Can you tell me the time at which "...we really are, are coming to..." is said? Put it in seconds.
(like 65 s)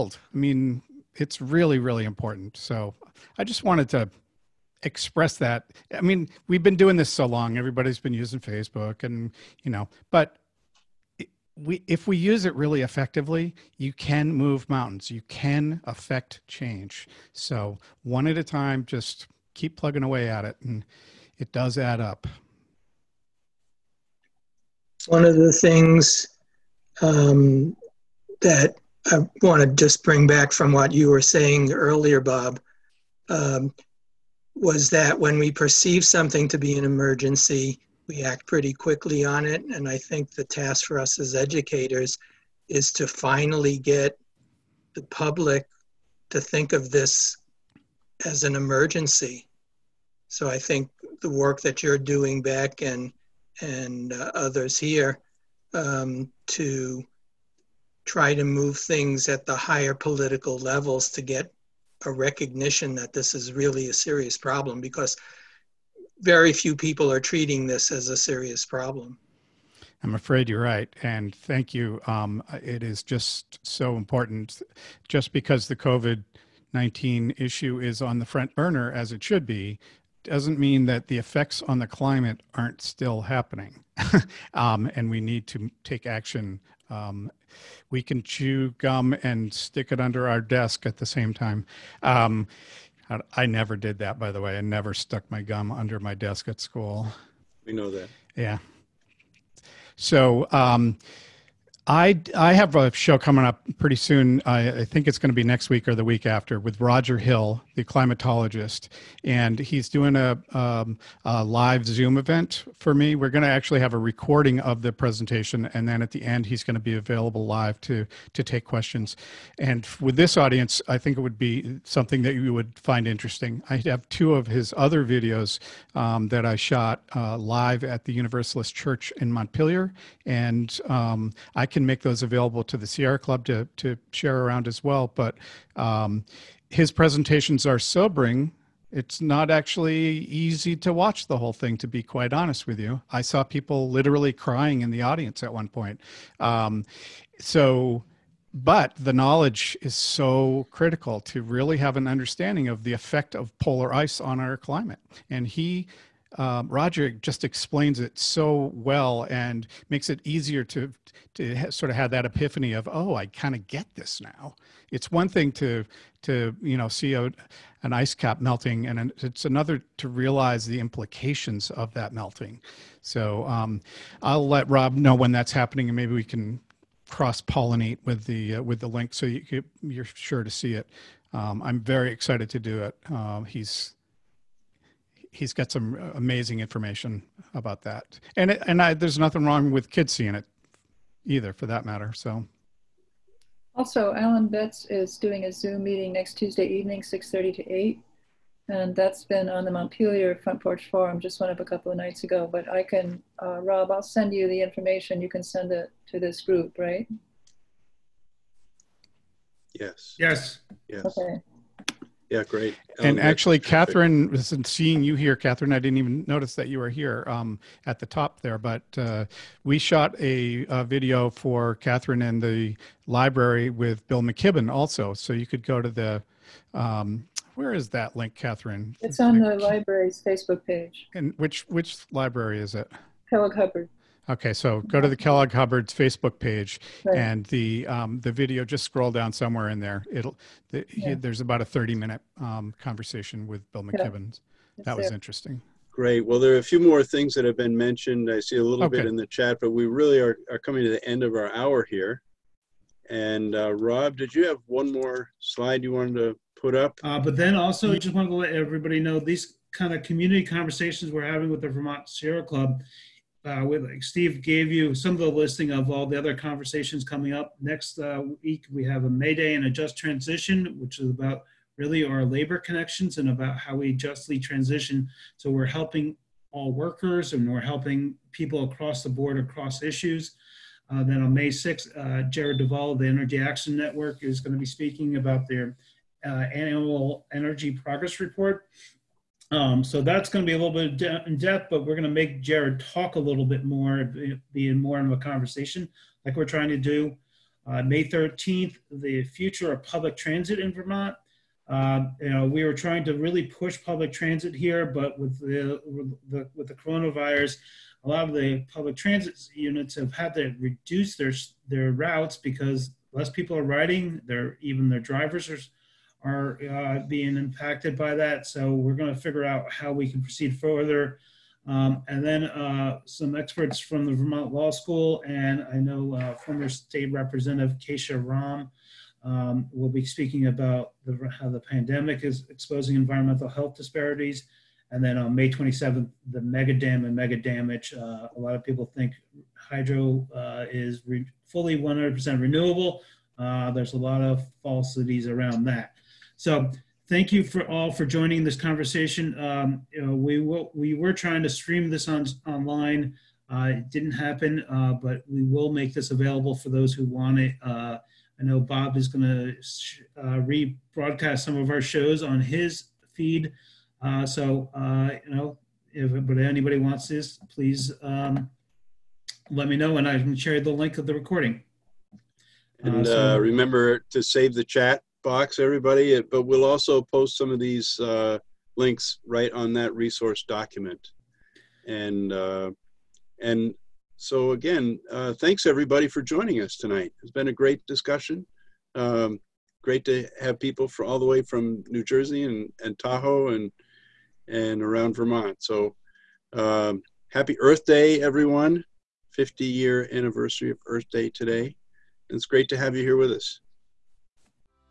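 249 s.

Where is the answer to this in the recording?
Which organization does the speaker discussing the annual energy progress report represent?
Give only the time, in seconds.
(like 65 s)
283 s.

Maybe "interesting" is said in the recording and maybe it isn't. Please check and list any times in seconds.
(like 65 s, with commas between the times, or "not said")
123 s, 245 s.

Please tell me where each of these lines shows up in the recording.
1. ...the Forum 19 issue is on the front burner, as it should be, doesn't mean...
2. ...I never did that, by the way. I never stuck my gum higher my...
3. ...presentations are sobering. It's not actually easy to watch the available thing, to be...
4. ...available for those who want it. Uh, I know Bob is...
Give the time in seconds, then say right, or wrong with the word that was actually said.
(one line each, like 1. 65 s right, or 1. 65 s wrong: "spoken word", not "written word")
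1. 75 s wrong: "COVID", not "Forum"
2. 93 s wrong: "under", not "higher"
3. 136 s wrong: "whole", not "available"
4. 356 s right.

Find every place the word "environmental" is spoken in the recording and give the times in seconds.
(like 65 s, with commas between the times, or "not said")
332 s.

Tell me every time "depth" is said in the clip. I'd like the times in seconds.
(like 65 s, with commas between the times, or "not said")
291 s.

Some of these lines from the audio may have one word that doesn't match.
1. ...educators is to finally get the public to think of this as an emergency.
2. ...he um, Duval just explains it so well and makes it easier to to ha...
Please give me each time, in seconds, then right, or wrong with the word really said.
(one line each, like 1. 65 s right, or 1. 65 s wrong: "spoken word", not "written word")
1. 41 s right
2. 155 s wrong: "Roger", not "Duval".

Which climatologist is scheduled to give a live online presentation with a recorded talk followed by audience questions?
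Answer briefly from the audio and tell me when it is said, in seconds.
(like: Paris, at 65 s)
Roger Hill, at 106 s.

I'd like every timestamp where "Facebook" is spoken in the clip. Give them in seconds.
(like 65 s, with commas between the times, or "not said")
8 s, 230 s, 235 s.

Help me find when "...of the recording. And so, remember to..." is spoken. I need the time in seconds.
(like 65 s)
370 s.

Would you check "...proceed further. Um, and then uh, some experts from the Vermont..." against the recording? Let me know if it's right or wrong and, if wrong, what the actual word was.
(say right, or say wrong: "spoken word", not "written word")
right.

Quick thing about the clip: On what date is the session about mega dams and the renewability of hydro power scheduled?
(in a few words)
May 27th.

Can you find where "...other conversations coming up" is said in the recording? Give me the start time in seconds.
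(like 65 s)
266 s.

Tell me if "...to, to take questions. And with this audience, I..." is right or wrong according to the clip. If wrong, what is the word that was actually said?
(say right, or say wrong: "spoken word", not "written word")
right.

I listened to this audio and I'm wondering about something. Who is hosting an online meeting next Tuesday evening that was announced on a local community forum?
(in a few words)
Alan Betts.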